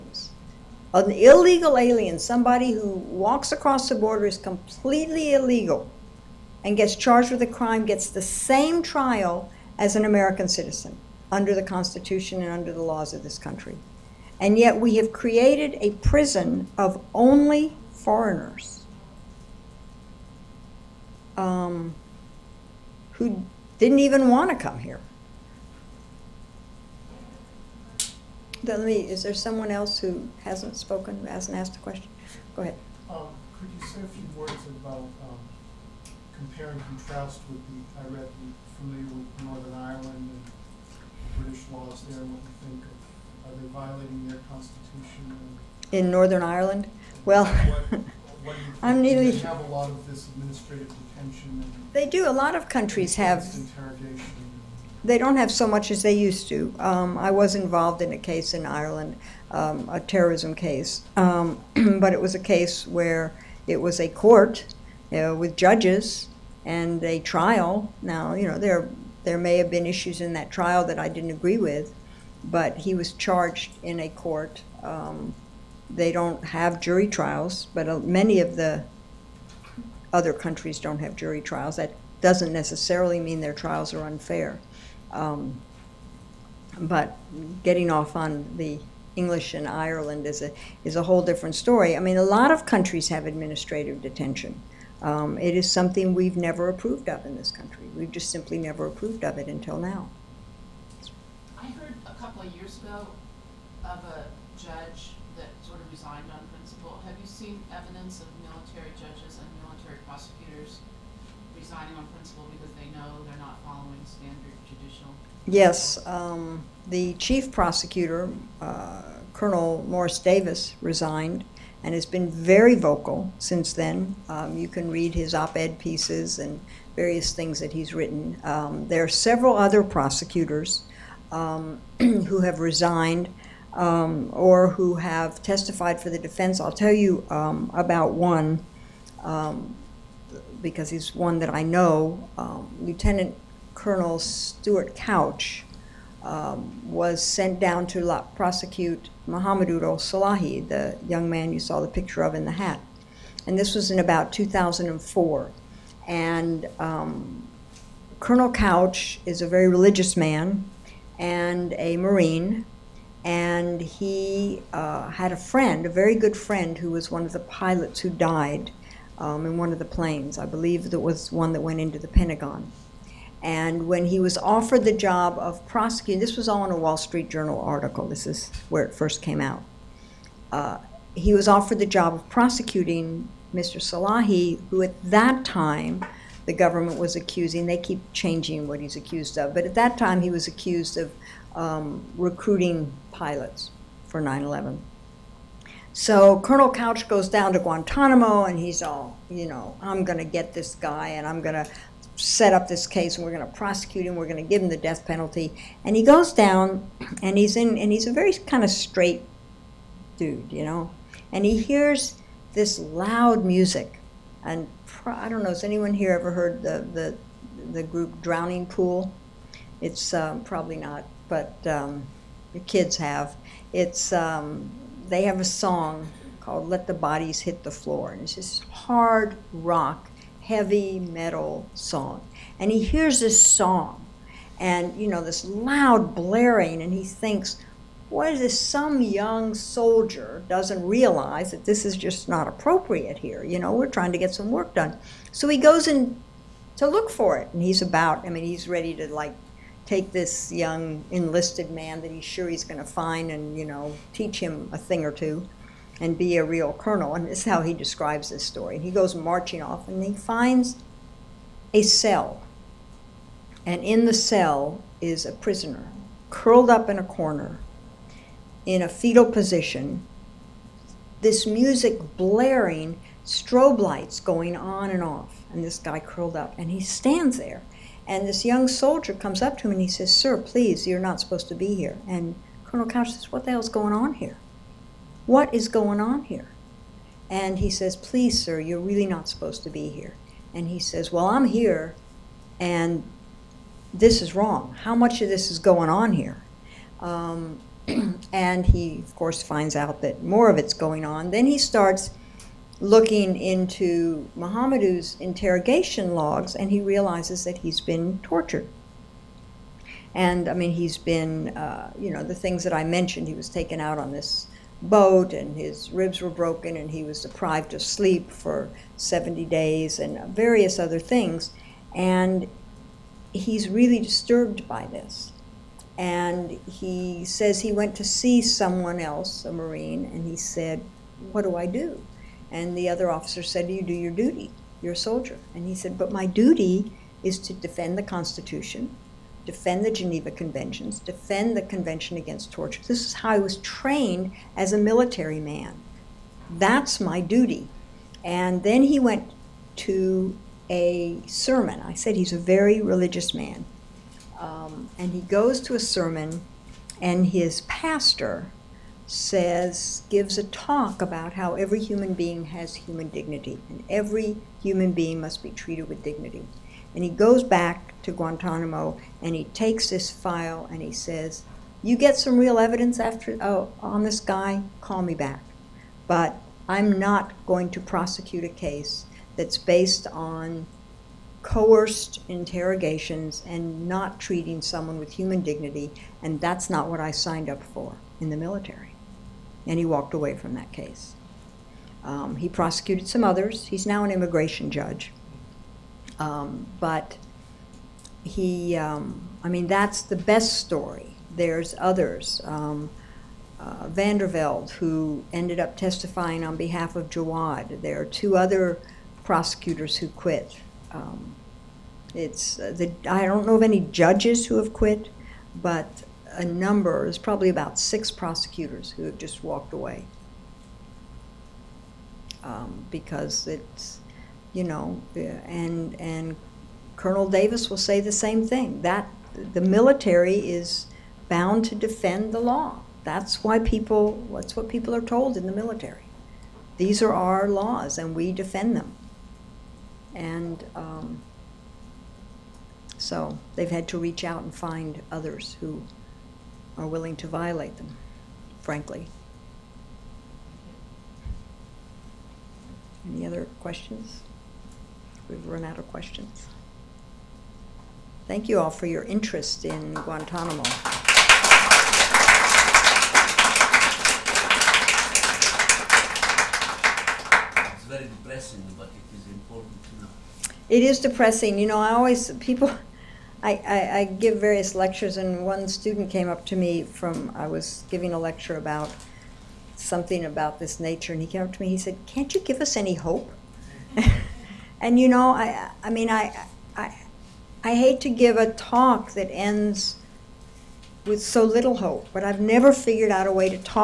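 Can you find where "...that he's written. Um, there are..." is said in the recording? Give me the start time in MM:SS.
02:07.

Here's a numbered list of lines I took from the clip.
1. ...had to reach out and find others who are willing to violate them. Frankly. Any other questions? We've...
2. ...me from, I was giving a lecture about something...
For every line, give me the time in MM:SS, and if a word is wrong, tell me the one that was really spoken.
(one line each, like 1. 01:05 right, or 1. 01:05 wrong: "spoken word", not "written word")
1. 07:23 right
2. 07:56 right.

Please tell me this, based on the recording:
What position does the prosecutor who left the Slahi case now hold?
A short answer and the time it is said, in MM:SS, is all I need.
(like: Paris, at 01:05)
immigration judge, at 06:34.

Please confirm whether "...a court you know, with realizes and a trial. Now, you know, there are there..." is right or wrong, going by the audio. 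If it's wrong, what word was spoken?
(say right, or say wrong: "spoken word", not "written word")
wrong: "judges", not "realizes".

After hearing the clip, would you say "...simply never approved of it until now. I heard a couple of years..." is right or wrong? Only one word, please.
right.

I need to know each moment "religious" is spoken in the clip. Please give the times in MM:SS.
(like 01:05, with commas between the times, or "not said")
02:39, 05:52.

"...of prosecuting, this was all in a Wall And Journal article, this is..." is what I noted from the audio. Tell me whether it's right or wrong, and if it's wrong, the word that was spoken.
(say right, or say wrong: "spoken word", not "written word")
wrong: "Street", not "And".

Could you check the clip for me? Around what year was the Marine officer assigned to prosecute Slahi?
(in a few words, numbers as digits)
2004.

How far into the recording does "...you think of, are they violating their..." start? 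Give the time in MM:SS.
00:42.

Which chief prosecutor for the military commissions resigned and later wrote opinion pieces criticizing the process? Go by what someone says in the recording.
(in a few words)
Colonel Morris Davis.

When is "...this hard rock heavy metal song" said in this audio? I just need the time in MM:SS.
03:48.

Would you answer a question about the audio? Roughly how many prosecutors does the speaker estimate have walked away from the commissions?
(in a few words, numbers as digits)
6.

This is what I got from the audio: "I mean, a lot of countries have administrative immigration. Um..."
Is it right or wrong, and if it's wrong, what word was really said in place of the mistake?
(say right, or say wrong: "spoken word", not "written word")
wrong: "detention", not "immigration".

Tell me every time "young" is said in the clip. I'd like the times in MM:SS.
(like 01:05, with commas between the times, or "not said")
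02:31, 03:59, 04:10, 04:38.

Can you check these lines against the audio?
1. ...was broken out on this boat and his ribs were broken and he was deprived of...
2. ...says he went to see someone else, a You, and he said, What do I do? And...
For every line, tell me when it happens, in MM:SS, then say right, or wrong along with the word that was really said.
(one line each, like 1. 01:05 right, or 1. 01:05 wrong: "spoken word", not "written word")
1. 05:13 wrong: "taken", not "broken"
2. 05:27 wrong: "Marine", not "You".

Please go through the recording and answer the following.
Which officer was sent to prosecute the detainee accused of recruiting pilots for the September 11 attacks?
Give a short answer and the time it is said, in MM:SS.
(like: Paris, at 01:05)
Lieutenant Colonel Stuart Couch, at 02:22.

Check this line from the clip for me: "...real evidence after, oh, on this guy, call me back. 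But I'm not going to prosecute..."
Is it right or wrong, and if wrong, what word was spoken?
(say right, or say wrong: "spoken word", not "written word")
right.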